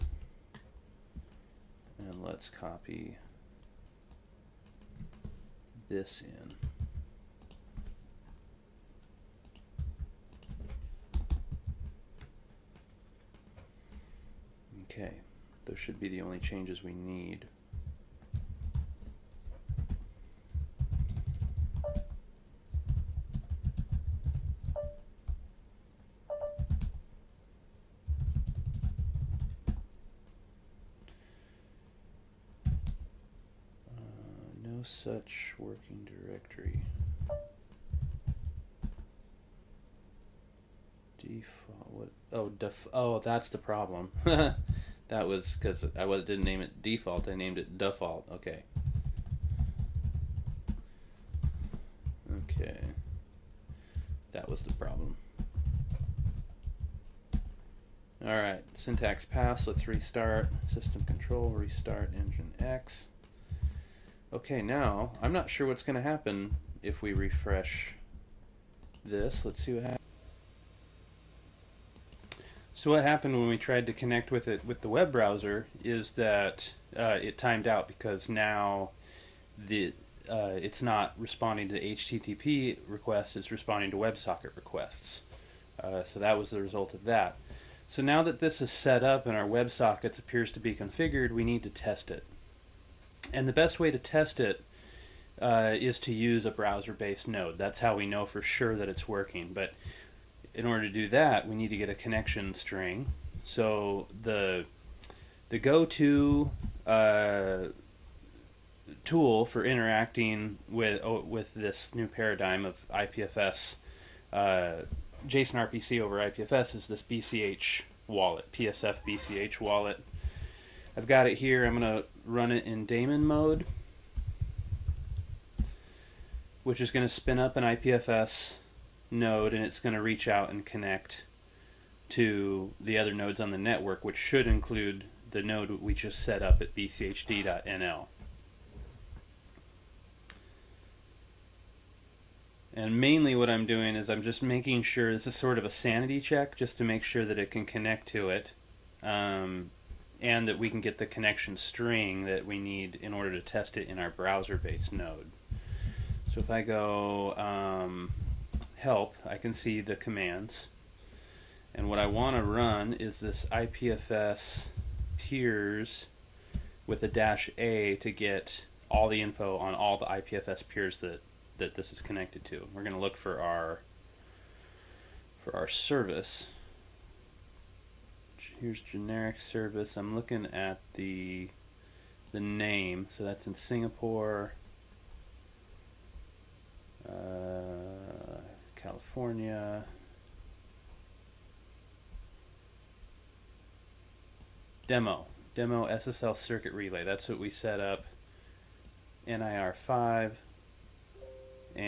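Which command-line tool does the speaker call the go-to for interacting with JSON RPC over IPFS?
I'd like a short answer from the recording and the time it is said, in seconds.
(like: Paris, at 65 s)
PSF BCH wallet, at 118 s.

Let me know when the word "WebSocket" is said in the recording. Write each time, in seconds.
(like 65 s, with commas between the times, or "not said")
83 s, 89 s.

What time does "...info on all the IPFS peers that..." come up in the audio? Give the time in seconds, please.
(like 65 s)
169 s.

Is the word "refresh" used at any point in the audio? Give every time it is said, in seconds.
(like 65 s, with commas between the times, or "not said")
67 s.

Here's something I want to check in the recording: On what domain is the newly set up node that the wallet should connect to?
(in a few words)
bchd.nl.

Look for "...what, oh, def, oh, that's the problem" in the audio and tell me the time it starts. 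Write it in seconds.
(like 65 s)
41 s.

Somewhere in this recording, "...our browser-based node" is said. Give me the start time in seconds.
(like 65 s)
153 s.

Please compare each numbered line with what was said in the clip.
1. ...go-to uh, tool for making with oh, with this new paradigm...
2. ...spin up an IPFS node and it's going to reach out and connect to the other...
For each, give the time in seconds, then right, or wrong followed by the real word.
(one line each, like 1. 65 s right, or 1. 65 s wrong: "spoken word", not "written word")
1. 105 s wrong: "interacting", not "making"
2. 127 s right.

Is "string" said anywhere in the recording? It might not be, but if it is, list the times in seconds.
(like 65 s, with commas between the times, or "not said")
102 s, 151 s.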